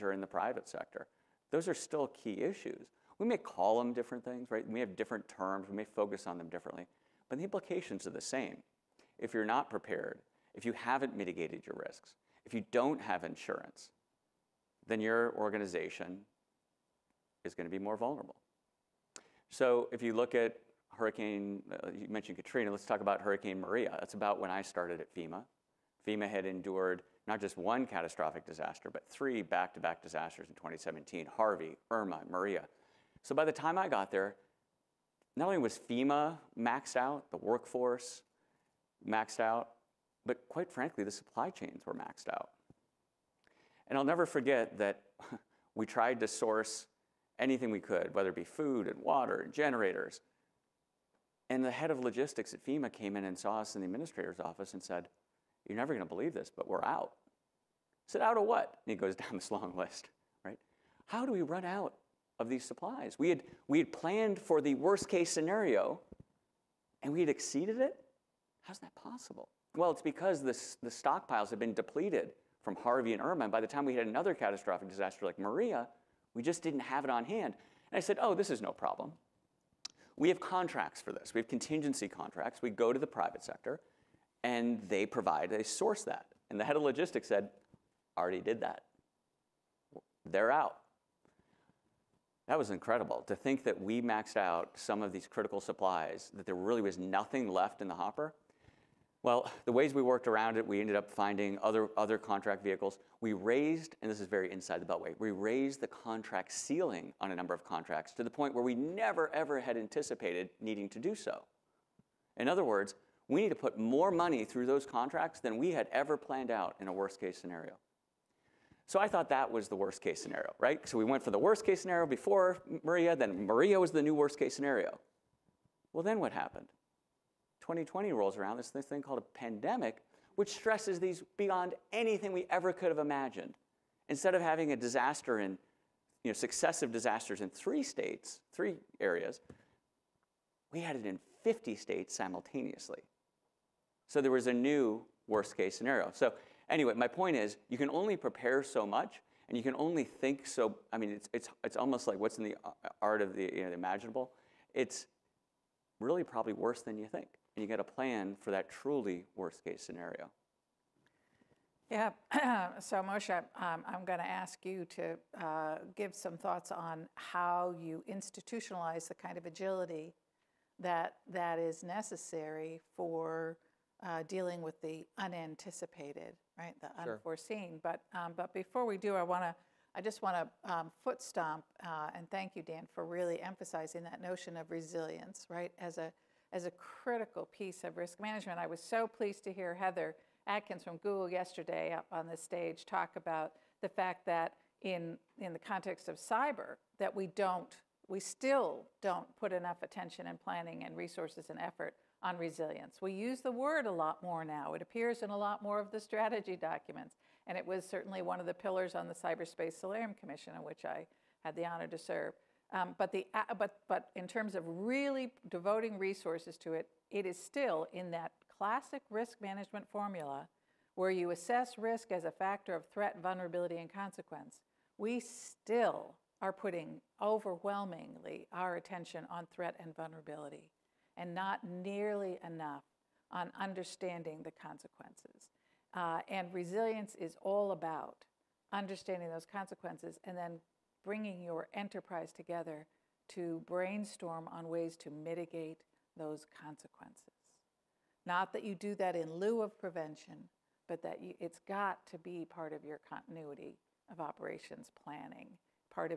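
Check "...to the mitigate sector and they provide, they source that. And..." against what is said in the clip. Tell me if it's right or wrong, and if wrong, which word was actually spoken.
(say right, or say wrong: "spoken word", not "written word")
wrong: "private", not "mitigate".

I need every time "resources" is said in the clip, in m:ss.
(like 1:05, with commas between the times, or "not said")
3:20, 3:35.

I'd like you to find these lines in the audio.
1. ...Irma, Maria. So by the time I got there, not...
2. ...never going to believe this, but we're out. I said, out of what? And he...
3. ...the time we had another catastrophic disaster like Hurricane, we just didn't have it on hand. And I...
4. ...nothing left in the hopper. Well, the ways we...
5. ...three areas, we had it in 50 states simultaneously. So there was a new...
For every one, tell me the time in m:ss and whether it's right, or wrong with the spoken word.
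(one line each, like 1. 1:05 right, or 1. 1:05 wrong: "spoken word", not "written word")
1. 0:31 right
2. 0:55 right
3. 1:13 wrong: "Maria", not "Hurricane"
4. 1:36 right
5. 2:18 right.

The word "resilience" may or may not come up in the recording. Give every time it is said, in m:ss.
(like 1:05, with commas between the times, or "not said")
3:04, 3:22, 3:56.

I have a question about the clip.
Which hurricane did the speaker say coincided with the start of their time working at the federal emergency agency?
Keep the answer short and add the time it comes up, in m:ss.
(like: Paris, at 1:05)
Hurricane Maria, at 0:23.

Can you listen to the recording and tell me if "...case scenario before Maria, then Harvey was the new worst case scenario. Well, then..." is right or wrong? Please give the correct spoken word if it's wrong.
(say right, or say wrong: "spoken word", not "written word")
wrong: "Maria", not "Harvey".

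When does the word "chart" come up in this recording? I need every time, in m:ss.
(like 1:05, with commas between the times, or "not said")
not said.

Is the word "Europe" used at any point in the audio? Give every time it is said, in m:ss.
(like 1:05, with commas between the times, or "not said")
not said.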